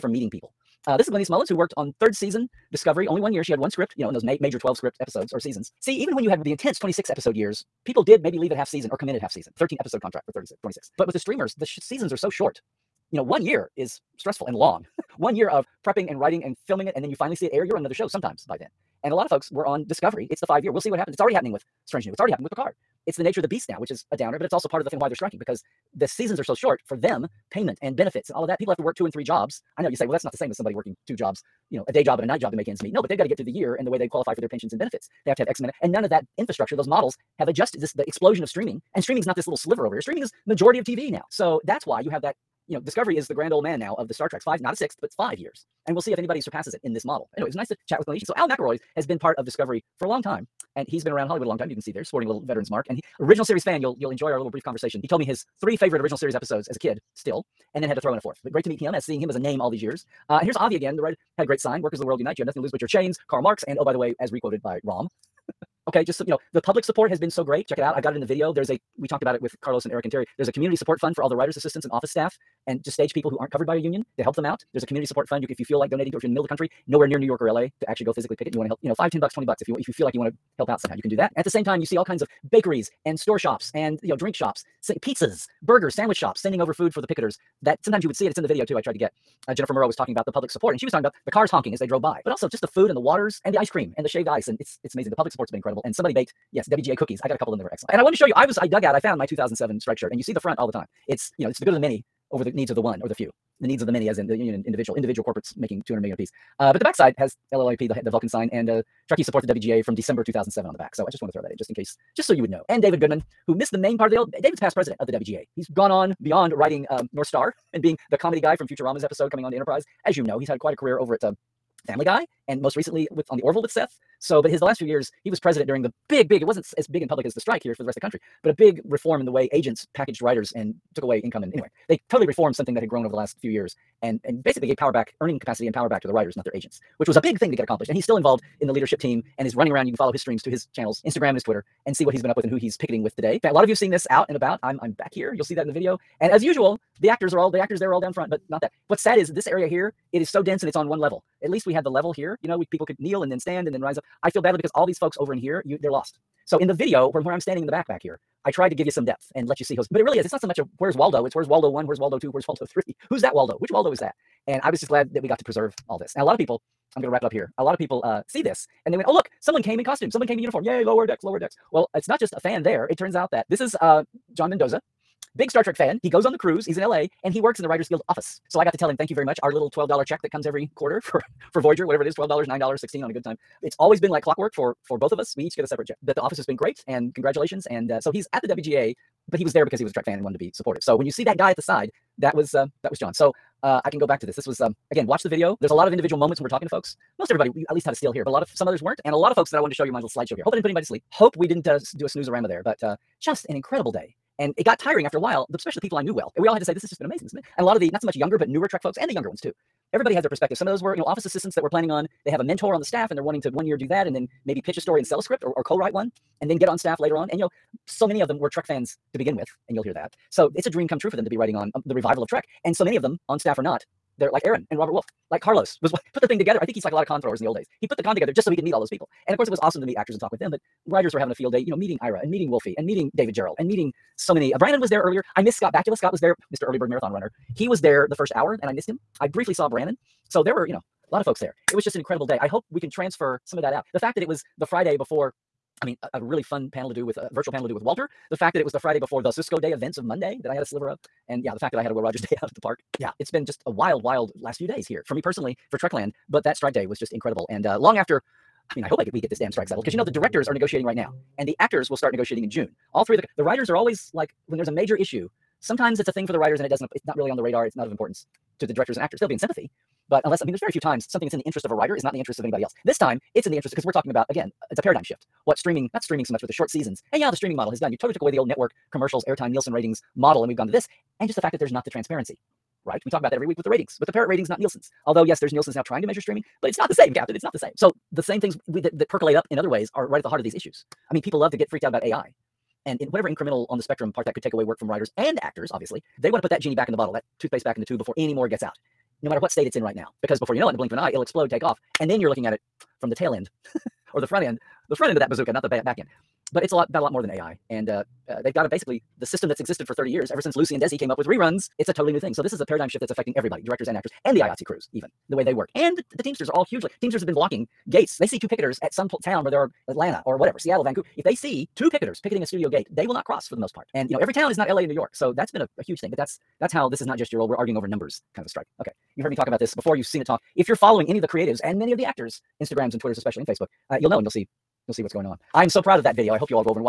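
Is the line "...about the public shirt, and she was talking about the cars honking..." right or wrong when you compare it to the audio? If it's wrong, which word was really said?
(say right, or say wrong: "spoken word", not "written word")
wrong: "support", not "shirt".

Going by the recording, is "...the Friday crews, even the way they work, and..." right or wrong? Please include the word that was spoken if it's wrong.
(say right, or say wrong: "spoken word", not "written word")
wrong: "IATSE", not "Friday".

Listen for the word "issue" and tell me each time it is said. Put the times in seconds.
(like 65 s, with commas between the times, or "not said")
264 s, 290 s.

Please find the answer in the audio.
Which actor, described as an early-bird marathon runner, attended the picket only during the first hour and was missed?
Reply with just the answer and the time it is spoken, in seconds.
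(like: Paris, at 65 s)
Scott Bakula, at 235 s.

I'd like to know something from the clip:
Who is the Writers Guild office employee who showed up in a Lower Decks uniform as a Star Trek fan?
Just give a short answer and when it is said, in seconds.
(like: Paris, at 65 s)
John Mendoza, at 174 s.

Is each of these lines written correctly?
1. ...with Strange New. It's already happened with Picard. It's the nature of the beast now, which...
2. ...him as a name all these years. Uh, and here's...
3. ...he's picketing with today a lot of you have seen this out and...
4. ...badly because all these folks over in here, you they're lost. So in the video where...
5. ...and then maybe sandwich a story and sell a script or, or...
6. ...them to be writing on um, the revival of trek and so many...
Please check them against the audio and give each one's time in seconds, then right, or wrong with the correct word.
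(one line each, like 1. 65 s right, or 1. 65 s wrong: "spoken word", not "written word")
1. 21 s right
2. 59 s right
3. 142 s right
4. 154 s right
5. 214 s wrong: "pitch", not "sandwich"
6. 221 s right.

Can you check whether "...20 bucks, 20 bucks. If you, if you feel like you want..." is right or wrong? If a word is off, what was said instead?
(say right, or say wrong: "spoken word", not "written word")
wrong: "10", not "20".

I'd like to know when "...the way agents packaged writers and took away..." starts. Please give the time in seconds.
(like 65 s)
129 s.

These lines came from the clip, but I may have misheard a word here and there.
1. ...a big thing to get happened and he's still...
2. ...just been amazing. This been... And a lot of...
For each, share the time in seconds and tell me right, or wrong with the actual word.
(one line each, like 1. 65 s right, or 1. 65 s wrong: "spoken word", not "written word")
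1. 137 s wrong: "accomplished", not "happened"
2. 206 s right.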